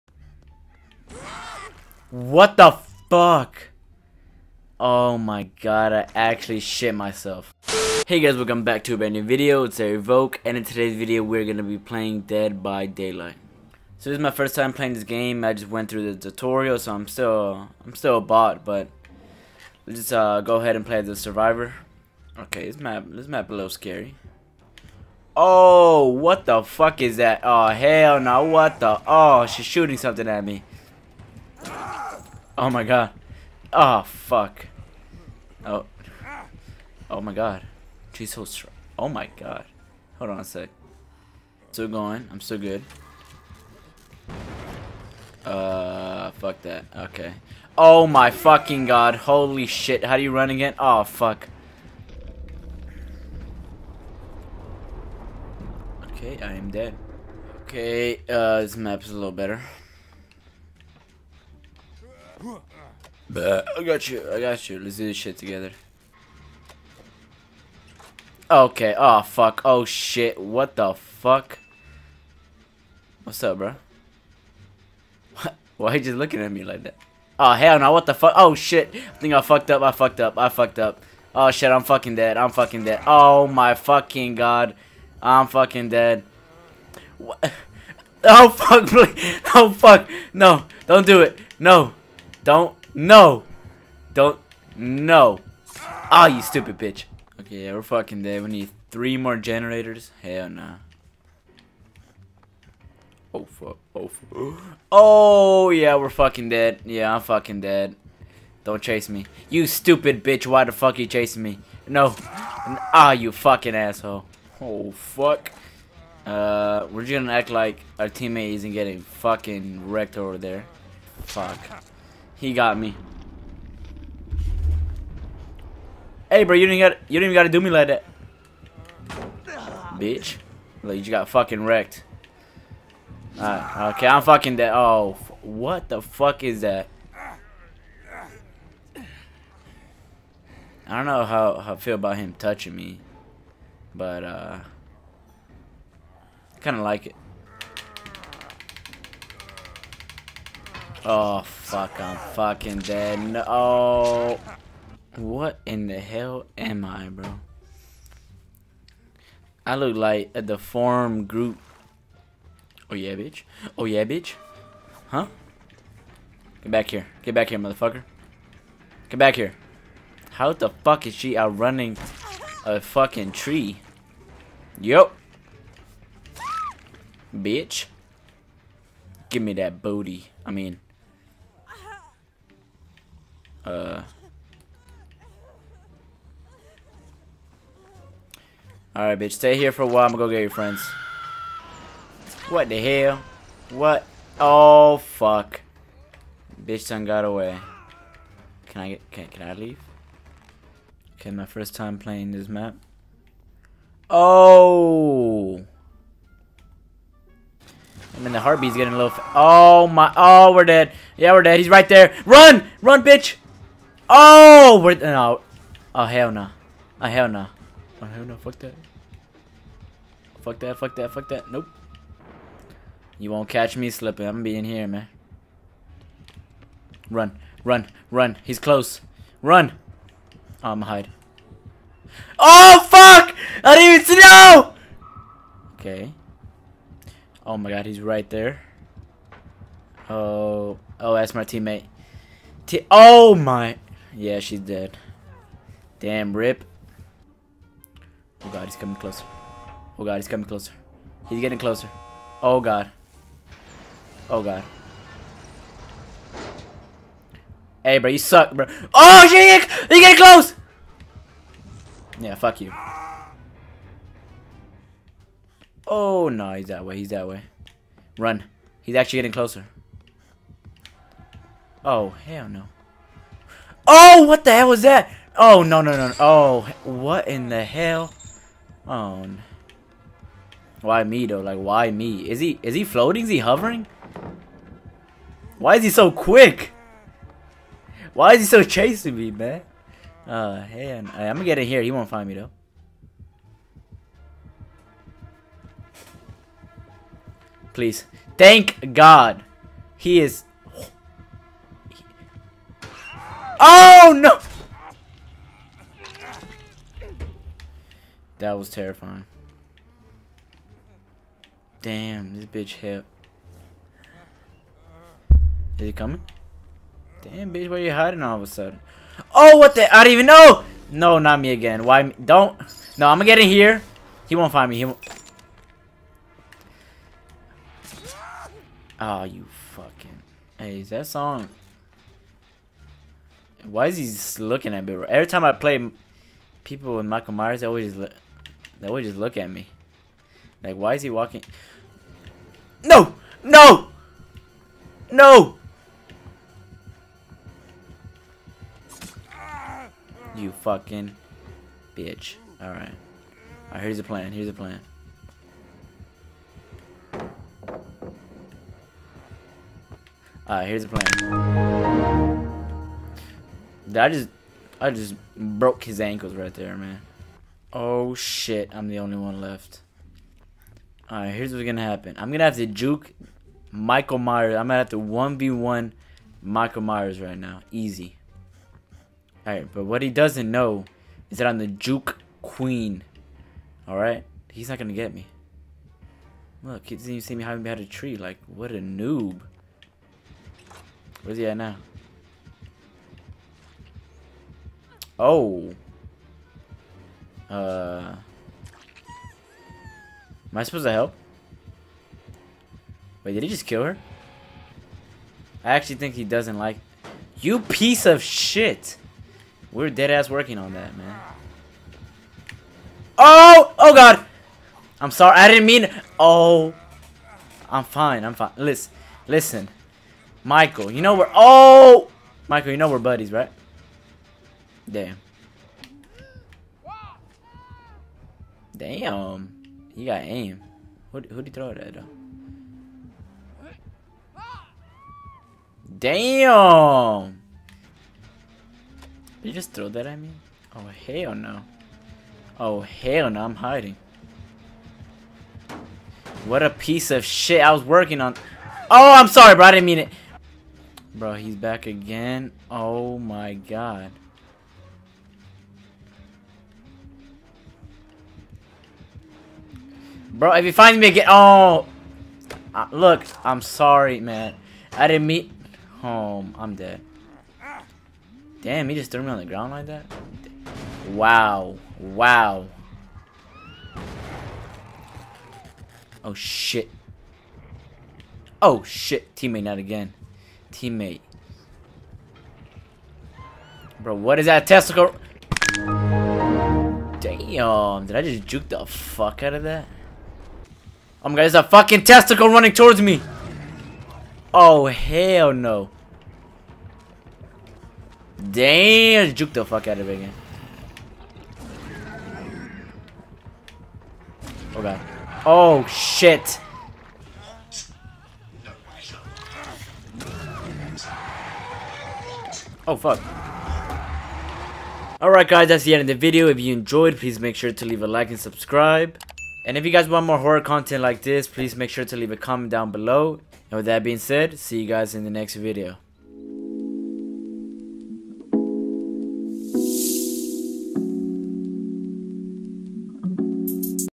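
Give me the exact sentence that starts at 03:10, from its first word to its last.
I'm gonna go get your friends.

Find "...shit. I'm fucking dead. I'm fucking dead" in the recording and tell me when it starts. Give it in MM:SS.
01:21.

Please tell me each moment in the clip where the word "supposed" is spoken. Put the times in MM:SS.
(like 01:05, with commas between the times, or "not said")
06:40.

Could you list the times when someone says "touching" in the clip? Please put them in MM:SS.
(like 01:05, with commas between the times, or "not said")
02:22.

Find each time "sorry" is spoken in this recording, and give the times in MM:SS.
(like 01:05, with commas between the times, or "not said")
06:55, 07:29, 07:43.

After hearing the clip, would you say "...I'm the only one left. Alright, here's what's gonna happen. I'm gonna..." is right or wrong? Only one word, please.
right.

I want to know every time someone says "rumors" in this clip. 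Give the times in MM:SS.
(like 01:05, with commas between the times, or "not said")
not said.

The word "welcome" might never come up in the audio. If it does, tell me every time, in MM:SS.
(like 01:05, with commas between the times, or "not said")
00:08.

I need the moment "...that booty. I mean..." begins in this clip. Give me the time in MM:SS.
02:59.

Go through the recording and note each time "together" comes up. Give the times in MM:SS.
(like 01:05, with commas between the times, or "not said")
01:05.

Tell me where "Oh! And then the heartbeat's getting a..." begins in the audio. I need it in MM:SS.
03:24.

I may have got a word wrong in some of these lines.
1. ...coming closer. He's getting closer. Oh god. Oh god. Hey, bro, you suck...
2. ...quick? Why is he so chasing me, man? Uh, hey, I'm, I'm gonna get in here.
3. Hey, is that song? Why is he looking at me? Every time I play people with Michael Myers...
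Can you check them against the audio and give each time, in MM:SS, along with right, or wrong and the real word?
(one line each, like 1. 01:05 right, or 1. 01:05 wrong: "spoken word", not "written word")
1. 04:10 right
2. 04:46 right
3. 05:30 right.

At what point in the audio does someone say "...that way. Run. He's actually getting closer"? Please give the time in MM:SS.
04:27.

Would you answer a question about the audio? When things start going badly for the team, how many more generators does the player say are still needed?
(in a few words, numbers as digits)
3.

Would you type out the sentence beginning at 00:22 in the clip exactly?
Okay, this map this map a little scary.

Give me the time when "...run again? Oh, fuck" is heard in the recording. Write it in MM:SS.
00:50.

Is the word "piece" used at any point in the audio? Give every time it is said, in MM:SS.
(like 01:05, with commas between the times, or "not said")
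06:47, 07:26.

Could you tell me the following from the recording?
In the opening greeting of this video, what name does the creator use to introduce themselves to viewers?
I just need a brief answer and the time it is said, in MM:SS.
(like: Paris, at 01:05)
Evoke, at 00:09.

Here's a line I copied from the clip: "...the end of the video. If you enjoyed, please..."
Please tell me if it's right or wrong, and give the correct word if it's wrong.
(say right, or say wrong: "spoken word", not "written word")
right.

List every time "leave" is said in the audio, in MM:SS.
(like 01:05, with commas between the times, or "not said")
03:19, 08:37, 08:42.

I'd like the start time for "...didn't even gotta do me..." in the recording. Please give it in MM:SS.
02:07.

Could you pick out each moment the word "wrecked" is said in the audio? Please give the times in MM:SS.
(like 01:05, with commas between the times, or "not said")
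01:59, 02:11.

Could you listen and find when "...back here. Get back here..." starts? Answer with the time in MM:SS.
02:46.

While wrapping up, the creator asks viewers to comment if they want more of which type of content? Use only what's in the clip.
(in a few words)
horror.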